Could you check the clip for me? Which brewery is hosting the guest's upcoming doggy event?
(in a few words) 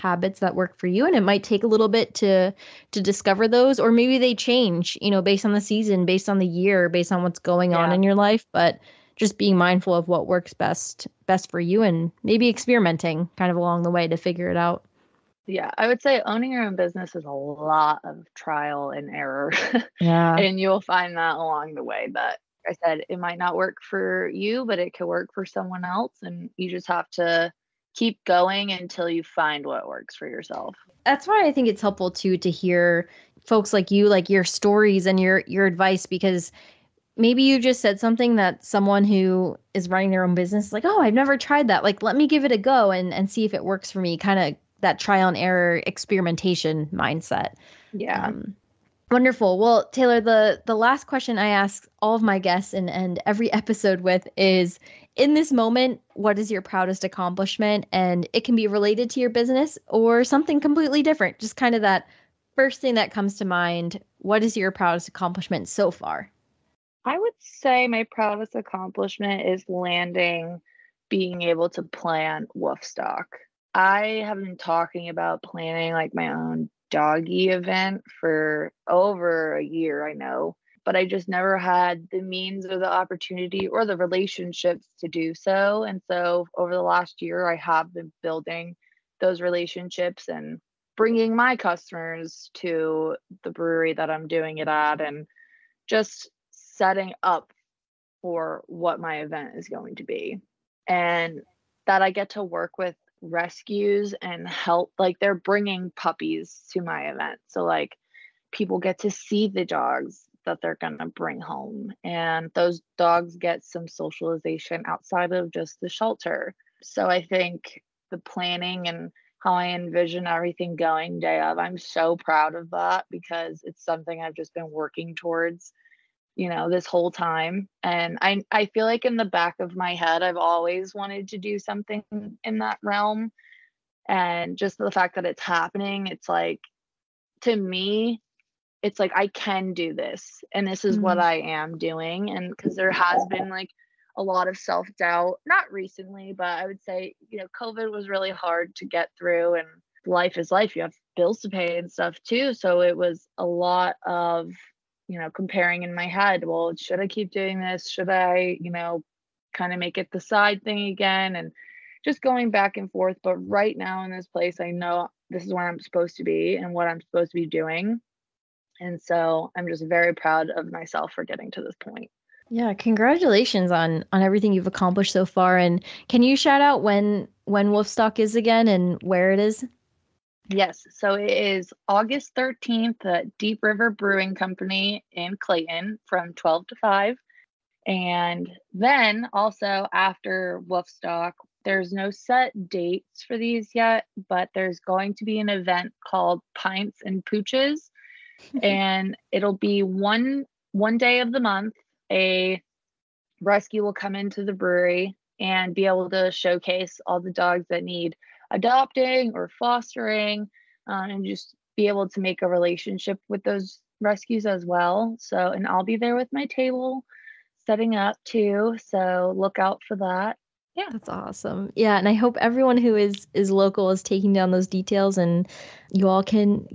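Deep River Brewing Company.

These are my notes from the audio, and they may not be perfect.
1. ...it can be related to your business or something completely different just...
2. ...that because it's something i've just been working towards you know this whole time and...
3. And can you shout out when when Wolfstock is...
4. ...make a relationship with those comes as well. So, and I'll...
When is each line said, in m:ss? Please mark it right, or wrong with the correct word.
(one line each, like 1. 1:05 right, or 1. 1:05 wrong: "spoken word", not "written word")
1. 0:58 right
2. 2:02 right
3. 2:55 right
4. 3:32 wrong: "rescues", not "comes".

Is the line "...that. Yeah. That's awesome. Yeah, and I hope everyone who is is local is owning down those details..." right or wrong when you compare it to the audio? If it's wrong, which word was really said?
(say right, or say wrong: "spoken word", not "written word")
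wrong: "taking", not "owning".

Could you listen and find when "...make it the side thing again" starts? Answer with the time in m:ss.
2:39.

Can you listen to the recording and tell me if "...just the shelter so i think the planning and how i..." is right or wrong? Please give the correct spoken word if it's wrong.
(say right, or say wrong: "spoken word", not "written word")
right.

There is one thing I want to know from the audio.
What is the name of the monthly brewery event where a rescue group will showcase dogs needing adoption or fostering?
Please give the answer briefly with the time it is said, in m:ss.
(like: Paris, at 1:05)
Pints and Pooches, at 3:16.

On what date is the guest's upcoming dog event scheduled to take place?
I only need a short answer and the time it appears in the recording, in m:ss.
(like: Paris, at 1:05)
August 13th, at 3:01.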